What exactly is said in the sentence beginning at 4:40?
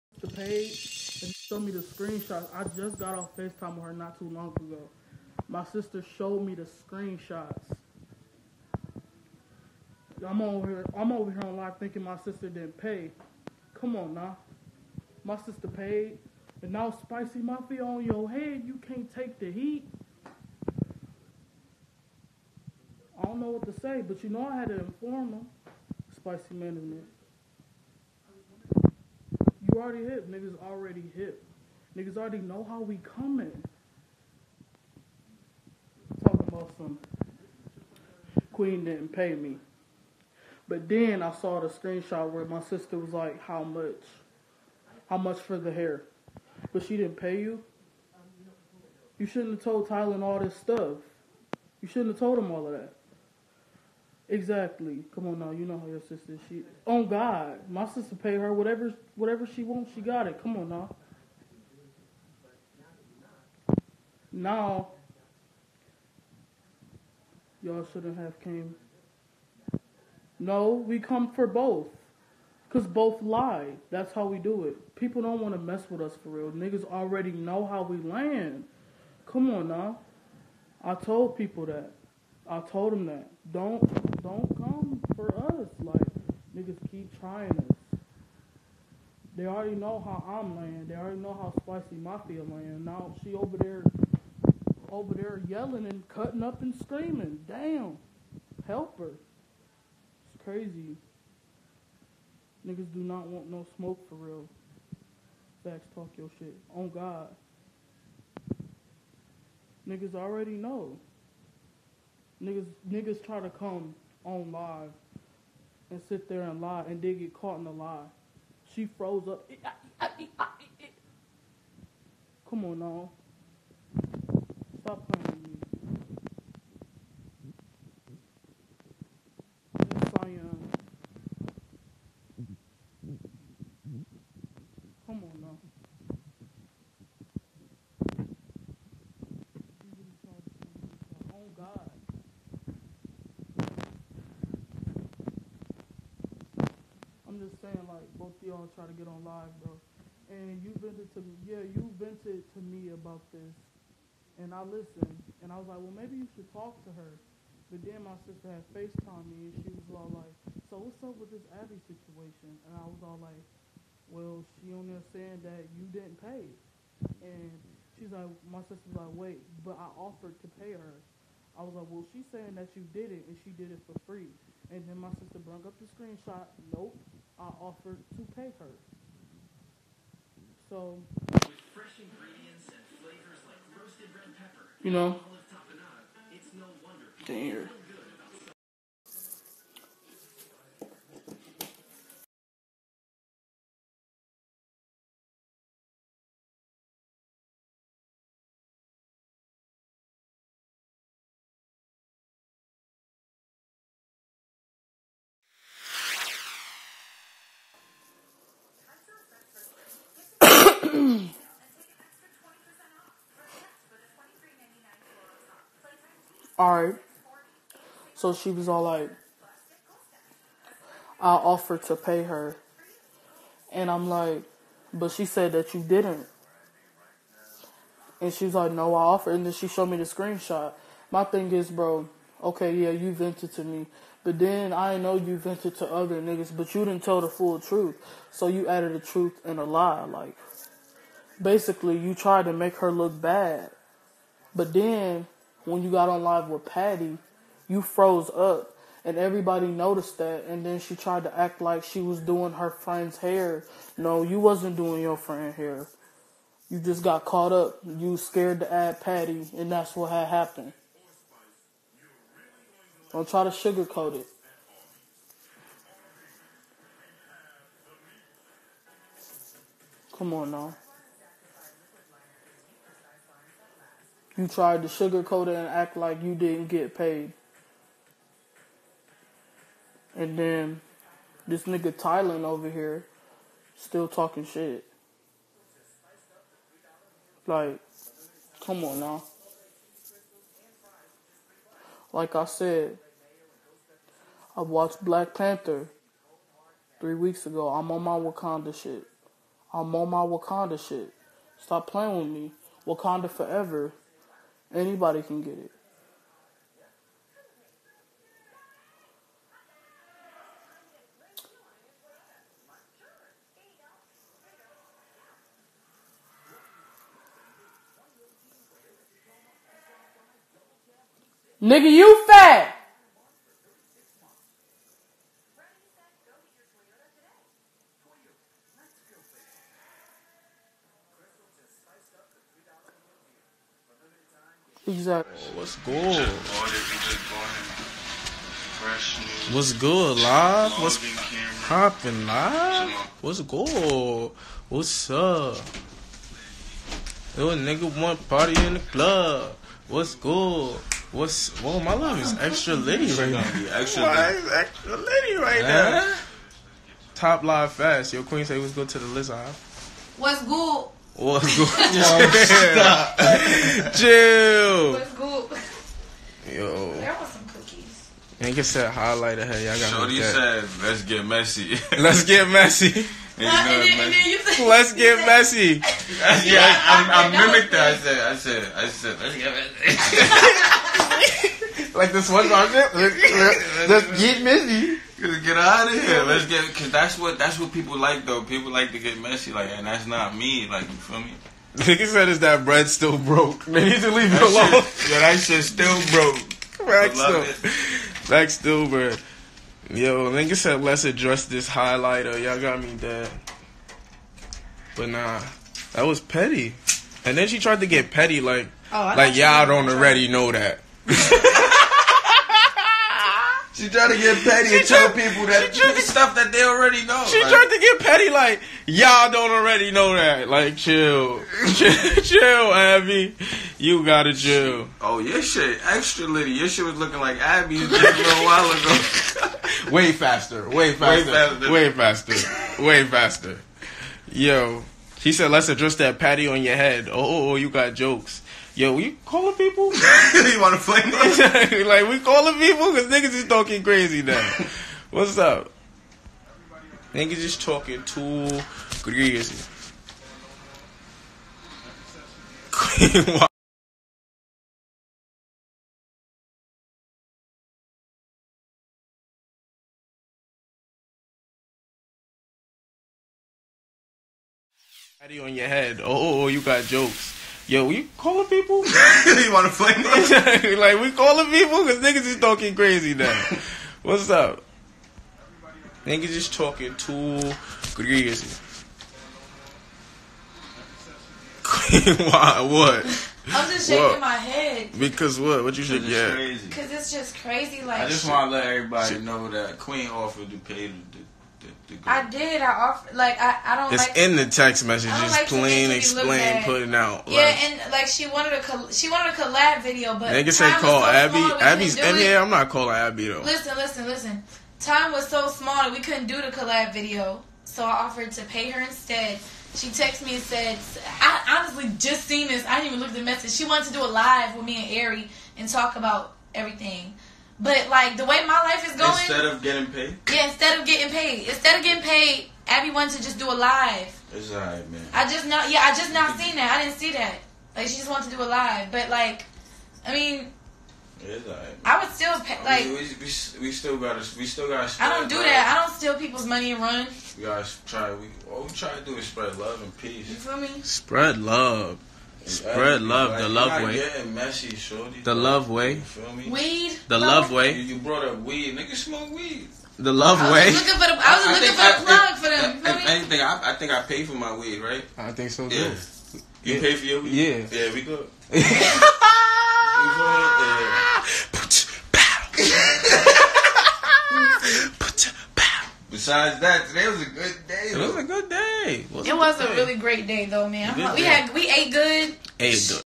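And then this nigga Tylen over here still talking shit.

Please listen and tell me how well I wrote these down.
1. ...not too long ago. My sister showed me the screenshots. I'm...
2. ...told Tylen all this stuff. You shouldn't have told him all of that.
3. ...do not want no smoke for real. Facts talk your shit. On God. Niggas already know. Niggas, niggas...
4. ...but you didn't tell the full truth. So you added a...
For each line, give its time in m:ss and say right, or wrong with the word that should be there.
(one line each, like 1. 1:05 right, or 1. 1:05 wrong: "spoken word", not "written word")
1. 0:03 right
2. 0:49 right
3. 1:42 right
4. 3:56 right.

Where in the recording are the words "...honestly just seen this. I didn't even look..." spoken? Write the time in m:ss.
8:31.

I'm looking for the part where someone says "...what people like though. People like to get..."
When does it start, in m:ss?
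6:27.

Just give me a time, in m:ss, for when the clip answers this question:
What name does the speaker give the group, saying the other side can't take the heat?
0:16.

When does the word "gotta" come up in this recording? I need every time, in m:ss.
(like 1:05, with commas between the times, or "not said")
7:04, 8:57.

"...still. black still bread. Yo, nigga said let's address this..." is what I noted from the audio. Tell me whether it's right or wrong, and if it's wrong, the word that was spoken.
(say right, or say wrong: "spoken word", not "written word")
right.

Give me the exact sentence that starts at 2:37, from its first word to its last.
But then my sister had FaceTime me, and she was all like, so what's up with this Abby situation?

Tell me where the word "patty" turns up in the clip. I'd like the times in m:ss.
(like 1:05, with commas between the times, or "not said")
4:06, 4:19, 7:16.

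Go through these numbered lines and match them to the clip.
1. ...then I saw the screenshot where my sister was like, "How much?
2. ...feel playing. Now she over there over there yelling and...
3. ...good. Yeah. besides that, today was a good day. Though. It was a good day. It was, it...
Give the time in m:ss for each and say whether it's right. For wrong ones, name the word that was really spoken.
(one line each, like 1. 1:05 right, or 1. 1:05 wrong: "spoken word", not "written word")
1. 0:40 right
2. 1:32 wrong: "laying", not "playing"
3. 9:18 right.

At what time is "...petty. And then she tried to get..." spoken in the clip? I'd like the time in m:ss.
6:46.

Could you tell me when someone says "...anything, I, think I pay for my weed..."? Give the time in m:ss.
9:13.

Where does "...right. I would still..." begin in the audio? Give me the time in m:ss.
8:51.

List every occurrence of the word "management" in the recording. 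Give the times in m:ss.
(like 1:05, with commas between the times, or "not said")
0:26.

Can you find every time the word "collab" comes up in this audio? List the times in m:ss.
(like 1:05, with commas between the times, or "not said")
8:19, 8:26.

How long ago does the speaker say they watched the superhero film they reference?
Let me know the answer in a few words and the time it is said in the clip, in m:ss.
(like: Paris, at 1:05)
3 weeks, at 4:56.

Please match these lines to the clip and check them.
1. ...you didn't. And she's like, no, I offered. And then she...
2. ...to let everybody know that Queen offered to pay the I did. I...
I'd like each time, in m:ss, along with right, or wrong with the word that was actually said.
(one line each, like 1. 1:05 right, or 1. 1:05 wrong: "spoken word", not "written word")
1. 3:45 right
2. 8:08 right.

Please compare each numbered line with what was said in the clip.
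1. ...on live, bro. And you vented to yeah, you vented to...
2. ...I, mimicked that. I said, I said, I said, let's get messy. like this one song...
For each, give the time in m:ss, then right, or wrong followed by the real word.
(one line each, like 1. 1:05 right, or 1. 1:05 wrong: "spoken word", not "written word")
1. 2:29 right
2. 6:17 right.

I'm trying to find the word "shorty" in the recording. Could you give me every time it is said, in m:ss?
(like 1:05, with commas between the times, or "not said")
6:09, 9:04.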